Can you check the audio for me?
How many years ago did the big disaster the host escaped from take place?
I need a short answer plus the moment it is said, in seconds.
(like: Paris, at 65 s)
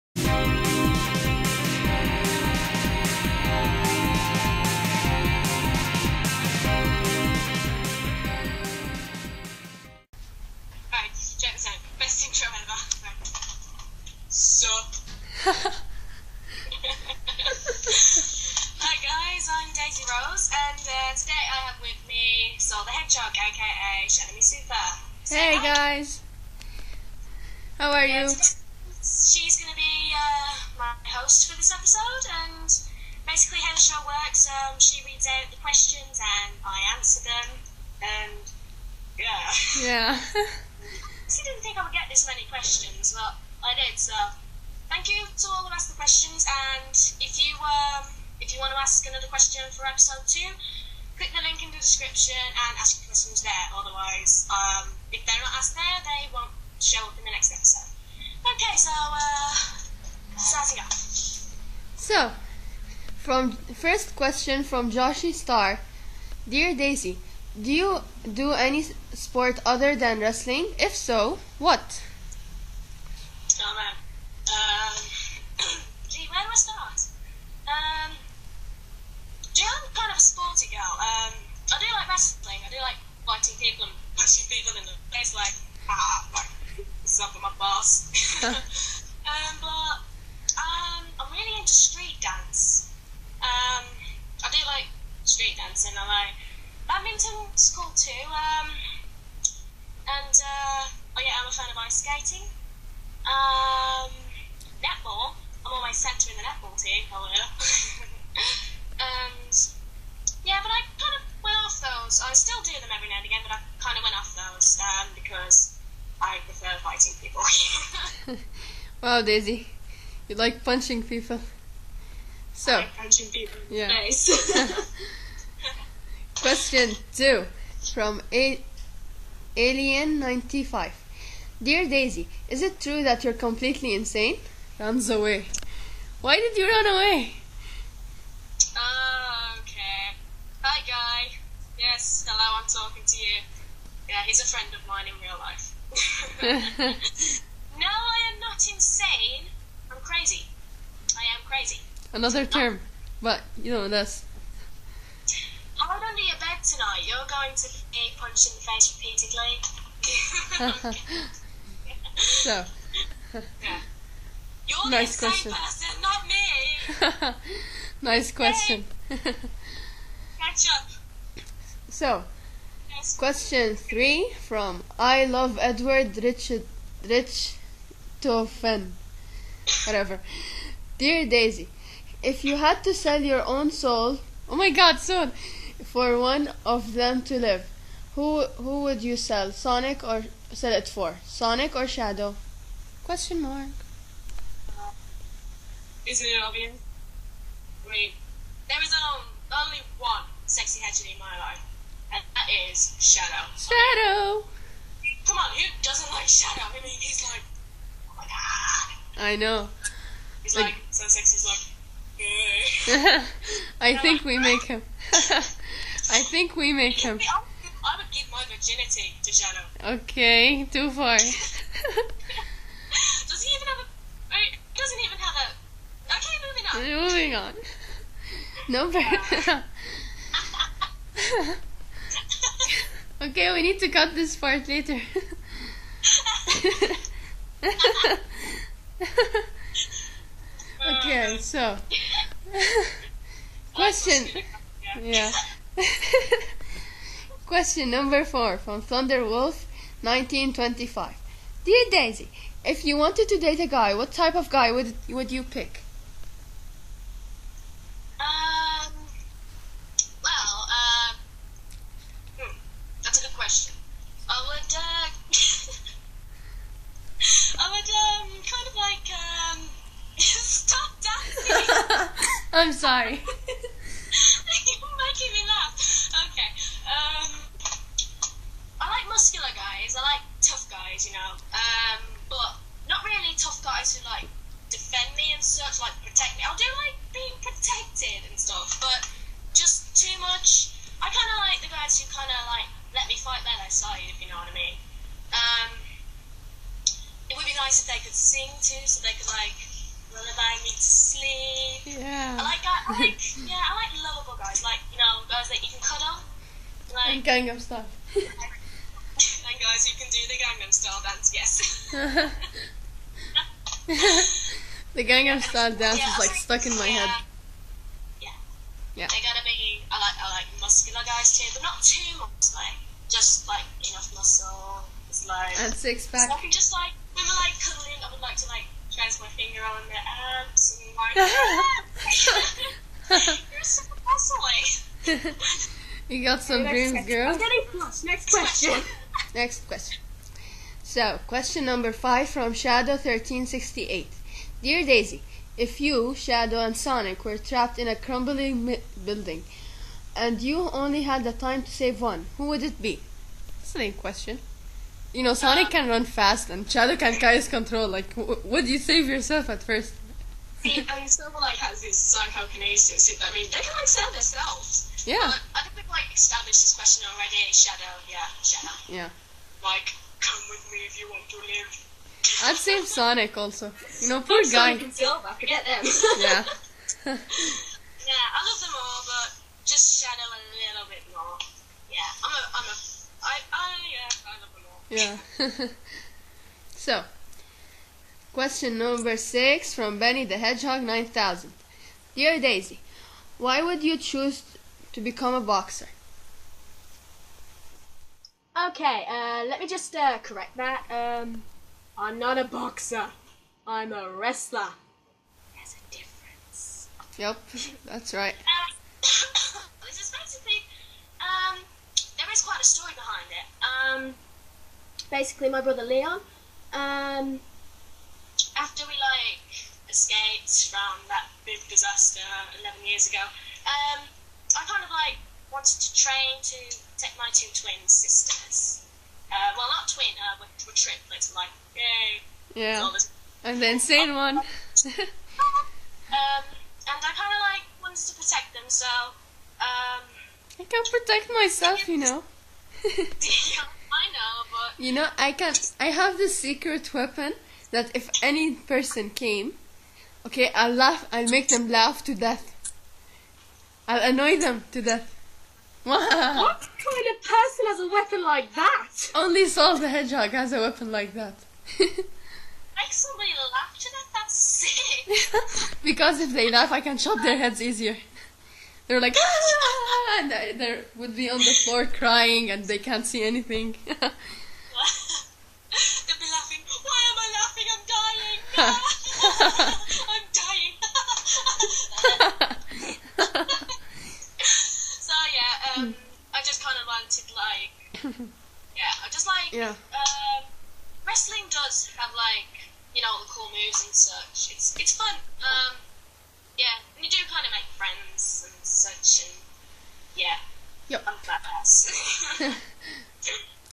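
11, at 422 s.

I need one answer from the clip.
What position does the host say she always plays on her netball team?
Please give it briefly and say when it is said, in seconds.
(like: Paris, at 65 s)
Centre, at 105 s.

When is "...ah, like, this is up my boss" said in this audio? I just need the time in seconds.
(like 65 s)
85 s.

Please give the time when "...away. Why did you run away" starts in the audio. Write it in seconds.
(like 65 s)
135 s.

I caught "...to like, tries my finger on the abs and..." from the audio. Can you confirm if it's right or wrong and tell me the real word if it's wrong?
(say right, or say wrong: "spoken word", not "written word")
right.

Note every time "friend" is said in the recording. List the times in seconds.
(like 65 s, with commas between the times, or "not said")
144 s, 497 s.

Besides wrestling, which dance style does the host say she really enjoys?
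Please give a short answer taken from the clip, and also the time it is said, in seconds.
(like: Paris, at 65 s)
Street dance, at 91 s.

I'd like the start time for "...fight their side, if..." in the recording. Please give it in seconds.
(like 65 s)
293 s.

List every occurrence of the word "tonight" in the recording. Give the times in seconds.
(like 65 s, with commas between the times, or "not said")
156 s.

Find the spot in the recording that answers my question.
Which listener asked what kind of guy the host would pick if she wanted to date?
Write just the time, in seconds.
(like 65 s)
248 s.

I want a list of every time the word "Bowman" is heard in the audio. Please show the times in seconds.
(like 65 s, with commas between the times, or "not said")
not said.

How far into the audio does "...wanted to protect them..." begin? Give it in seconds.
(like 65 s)
437 s.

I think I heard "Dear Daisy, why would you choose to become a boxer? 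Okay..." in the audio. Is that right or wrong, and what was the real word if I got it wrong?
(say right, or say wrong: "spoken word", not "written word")
right.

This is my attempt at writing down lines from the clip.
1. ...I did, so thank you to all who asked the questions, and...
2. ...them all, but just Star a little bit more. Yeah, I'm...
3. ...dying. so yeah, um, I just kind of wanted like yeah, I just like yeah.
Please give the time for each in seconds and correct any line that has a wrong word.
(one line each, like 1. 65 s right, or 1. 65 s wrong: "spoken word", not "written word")
1. 43 s right
2. 378 s wrong: "Shadow", not "Star"
3. 483 s right.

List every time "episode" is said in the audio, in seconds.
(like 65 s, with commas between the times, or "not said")
31 s, 49 s, 57 s.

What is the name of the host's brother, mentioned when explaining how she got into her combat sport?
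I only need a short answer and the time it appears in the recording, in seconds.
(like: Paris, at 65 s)
Leon, at 415 s.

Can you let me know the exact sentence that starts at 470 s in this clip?
and they would be on the floor crying and they can't see anything.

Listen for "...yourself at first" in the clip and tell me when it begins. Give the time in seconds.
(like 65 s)
359 s.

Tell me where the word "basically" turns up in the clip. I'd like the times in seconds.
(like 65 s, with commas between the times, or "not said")
33 s, 415 s.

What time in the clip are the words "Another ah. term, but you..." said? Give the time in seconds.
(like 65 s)
152 s.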